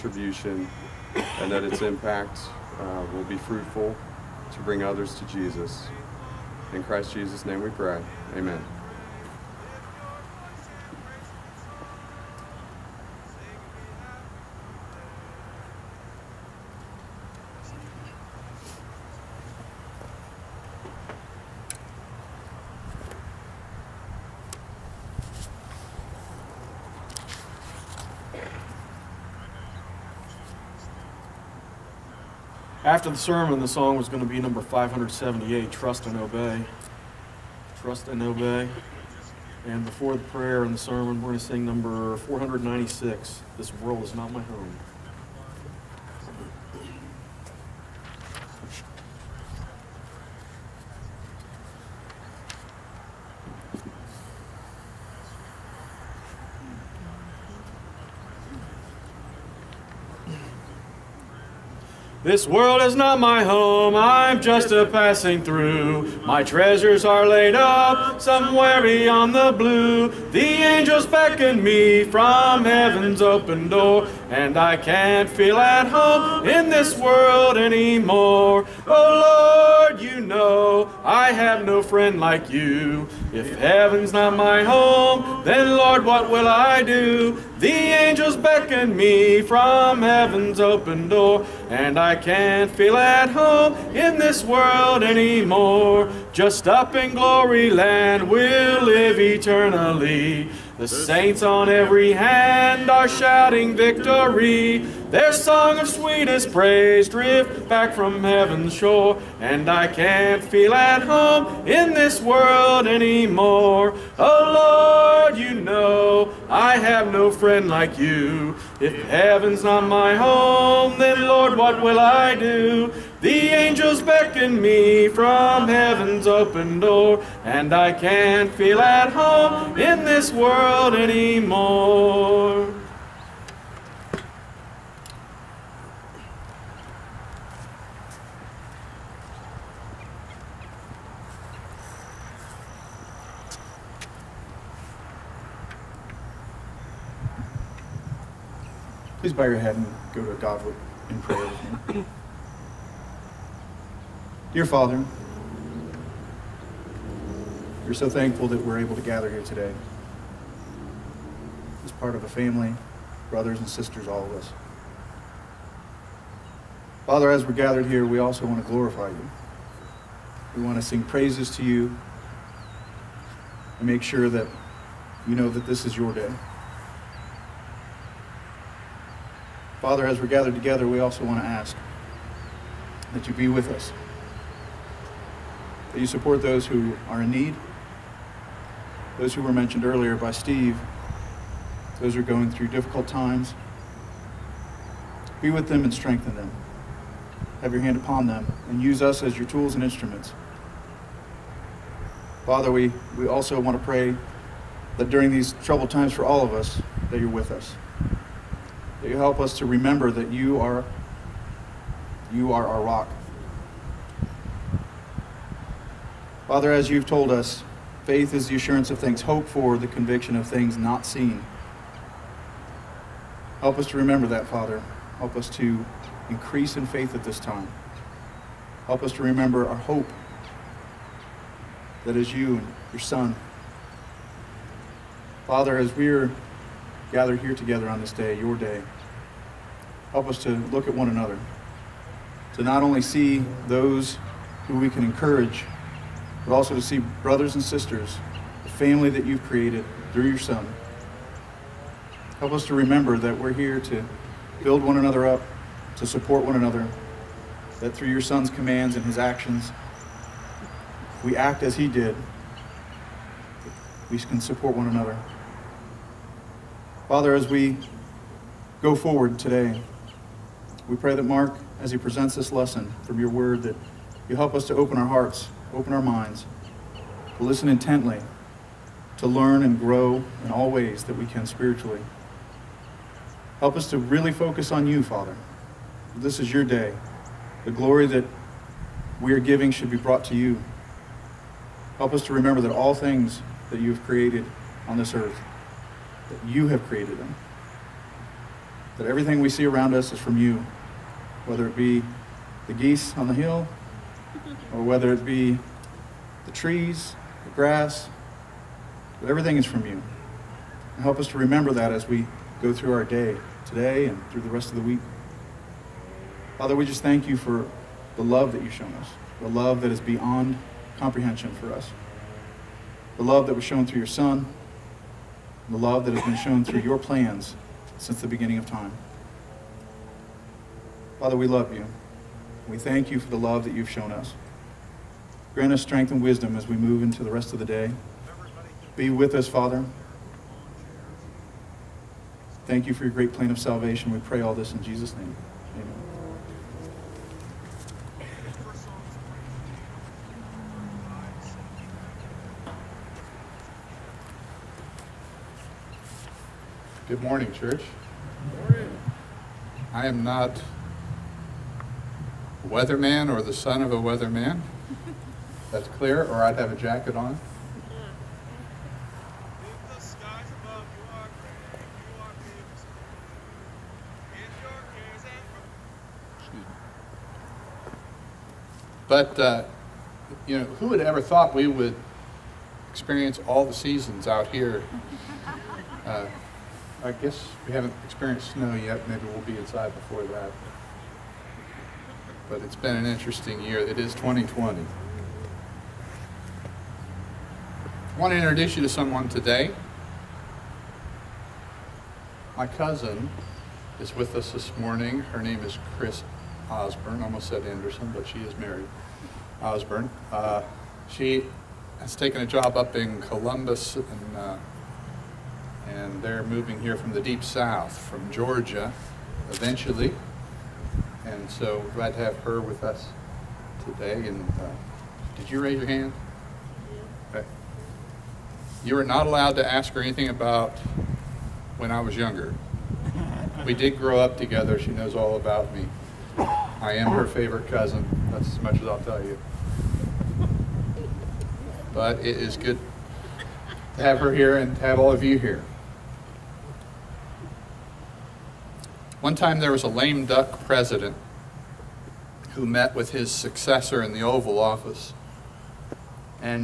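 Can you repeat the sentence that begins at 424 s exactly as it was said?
And uh, did you raise your hand?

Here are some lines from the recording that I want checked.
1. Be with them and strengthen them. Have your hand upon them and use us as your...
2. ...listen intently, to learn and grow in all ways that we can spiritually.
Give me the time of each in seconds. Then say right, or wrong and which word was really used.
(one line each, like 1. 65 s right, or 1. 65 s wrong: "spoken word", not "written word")
1. 195 s right
2. 277 s right.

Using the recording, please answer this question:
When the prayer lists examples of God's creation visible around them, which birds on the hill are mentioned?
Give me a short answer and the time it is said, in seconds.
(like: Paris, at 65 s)
Geese, at 302 s.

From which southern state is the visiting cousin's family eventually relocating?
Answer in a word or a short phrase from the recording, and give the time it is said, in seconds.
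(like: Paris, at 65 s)
Georgia, at 418 s.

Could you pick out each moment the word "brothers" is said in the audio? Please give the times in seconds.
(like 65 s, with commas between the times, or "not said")
163 s, 247 s.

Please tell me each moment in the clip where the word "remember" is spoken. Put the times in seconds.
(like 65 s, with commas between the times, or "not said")
209 s, 223 s, 229 s, 252 s, 292 s, 311 s.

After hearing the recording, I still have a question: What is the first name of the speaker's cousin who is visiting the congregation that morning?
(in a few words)
Chris.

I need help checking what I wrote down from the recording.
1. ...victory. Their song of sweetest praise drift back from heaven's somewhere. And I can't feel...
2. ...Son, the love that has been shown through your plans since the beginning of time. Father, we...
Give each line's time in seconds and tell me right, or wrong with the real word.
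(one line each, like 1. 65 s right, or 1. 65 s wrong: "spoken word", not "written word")
1. 103 s wrong: "shore", not "somewhere"
2. 324 s right.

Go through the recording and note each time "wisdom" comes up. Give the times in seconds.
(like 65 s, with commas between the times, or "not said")
336 s.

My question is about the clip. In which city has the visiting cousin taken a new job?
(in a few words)
Columbus.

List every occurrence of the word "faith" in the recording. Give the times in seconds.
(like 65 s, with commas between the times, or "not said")
218 s, 226 s.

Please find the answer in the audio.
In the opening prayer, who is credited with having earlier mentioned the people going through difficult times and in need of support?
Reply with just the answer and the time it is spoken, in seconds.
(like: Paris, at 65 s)
Steve, at 190 s.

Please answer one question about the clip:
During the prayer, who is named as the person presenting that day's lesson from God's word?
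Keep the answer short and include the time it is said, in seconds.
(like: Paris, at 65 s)
Mark, at 271 s.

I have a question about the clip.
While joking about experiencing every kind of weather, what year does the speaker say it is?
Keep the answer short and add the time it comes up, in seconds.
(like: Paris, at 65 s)
2020, at 394 s.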